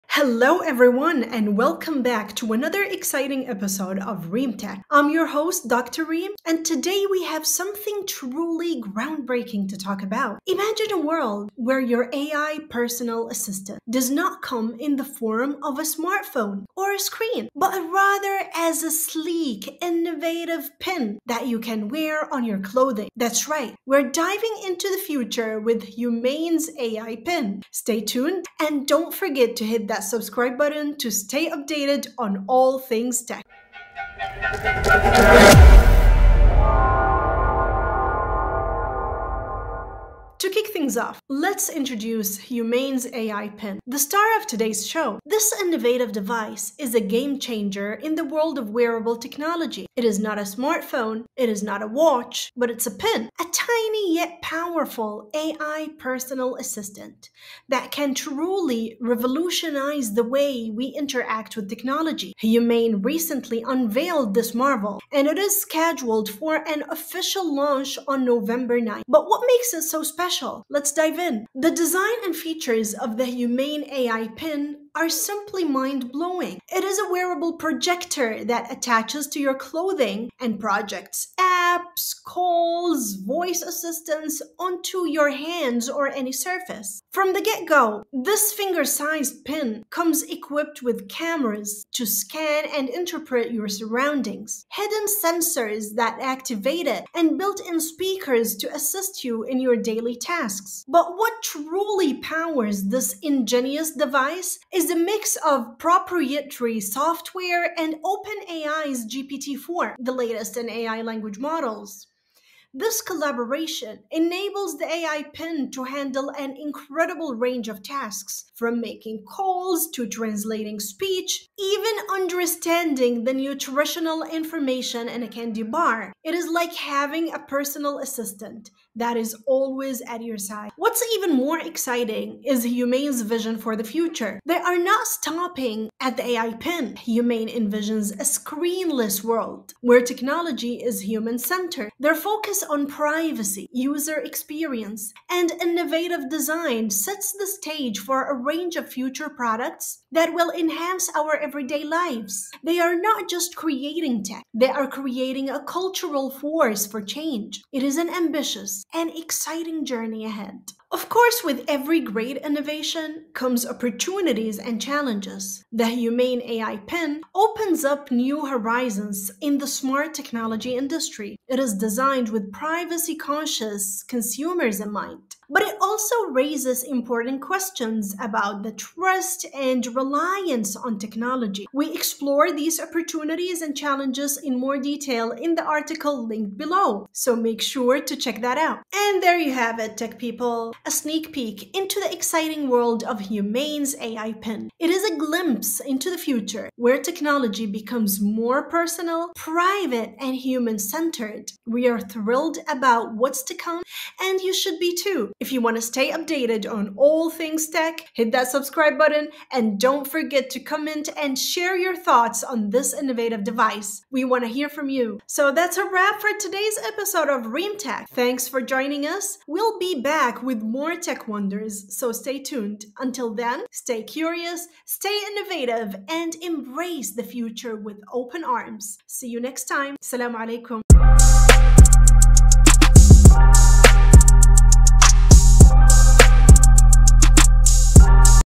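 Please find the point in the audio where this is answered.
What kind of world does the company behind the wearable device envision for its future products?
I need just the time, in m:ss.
2:18.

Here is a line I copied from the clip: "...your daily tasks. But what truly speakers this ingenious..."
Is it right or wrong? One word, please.
wrong.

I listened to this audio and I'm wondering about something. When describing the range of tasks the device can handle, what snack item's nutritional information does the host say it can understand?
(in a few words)
candy bar.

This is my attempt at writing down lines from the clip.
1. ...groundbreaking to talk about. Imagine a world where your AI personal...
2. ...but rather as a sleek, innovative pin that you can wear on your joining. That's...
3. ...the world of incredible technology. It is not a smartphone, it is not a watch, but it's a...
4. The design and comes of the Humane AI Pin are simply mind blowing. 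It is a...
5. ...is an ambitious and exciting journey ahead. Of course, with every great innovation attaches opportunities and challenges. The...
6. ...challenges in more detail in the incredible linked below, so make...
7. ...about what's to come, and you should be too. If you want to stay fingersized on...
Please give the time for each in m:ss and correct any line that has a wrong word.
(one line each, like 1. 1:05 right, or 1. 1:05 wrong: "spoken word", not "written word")
1. 0:08 right
2. 0:17 wrong: "clothing", not "joining"
3. 0:48 wrong: "wearable", not "incredible"
4. 1:11 wrong: "features", not "comes"
5. 2:37 wrong: "comes", not "attaches"
6. 3:03 wrong: "article", not "incredible"
7. 3:22 wrong: "updated", not "fingersized".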